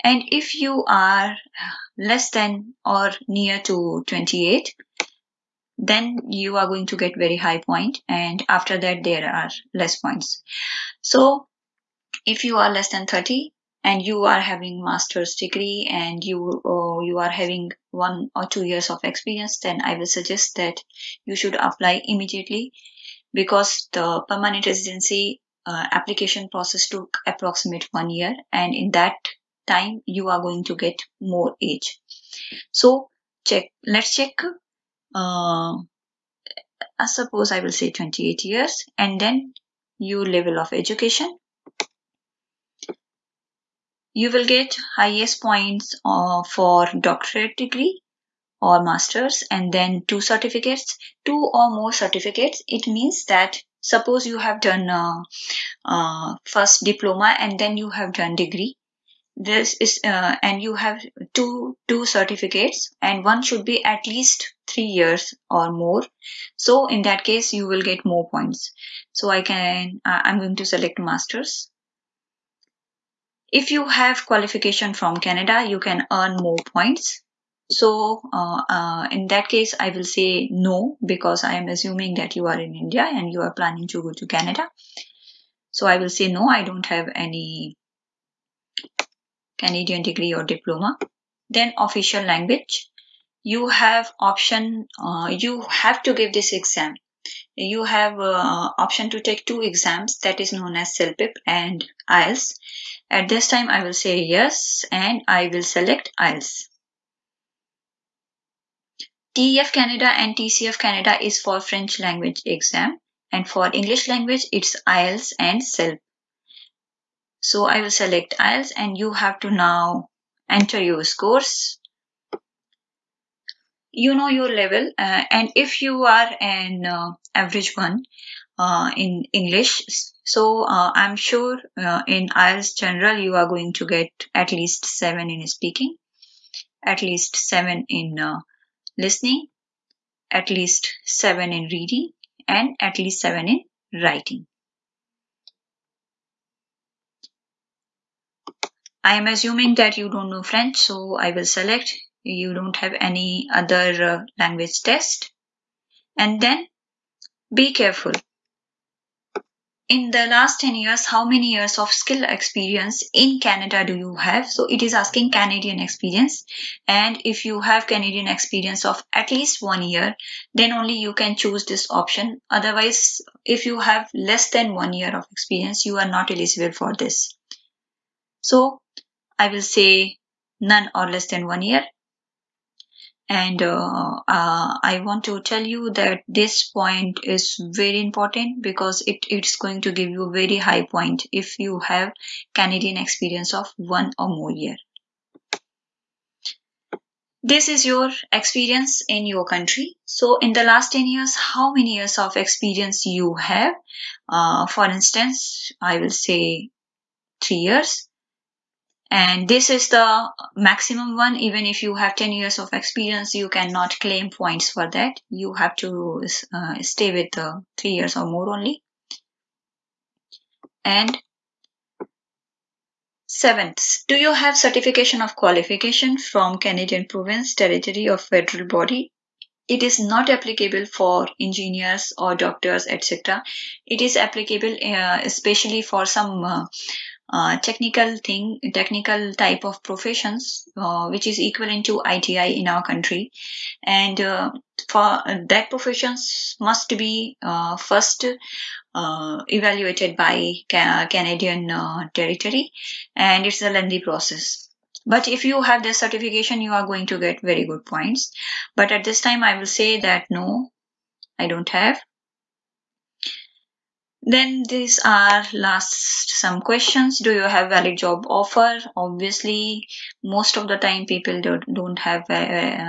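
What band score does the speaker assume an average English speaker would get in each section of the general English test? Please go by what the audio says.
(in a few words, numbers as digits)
7.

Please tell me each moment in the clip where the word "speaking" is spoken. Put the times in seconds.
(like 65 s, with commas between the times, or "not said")
135 s.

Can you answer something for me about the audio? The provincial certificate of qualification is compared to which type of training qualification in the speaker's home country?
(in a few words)
ITI.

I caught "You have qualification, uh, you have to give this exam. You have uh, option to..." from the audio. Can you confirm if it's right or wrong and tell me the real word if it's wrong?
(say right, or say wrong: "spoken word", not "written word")
wrong: "option", not "qualification".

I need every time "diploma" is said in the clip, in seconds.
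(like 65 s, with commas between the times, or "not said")
56 s, 90 s.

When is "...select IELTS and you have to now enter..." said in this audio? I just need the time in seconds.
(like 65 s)
117 s.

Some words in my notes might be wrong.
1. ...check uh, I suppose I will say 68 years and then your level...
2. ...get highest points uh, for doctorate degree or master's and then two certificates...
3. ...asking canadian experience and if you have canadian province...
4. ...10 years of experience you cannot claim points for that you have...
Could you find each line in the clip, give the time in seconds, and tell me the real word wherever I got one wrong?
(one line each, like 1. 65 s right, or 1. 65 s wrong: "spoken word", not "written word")
1. 34 s wrong: "28", not "68"
2. 44 s right
3. 164 s wrong: "experience", not "province"
4. 212 s right.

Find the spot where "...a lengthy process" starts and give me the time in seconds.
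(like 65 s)
253 s.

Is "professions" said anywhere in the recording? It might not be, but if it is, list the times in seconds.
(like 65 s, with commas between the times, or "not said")
239 s, 245 s.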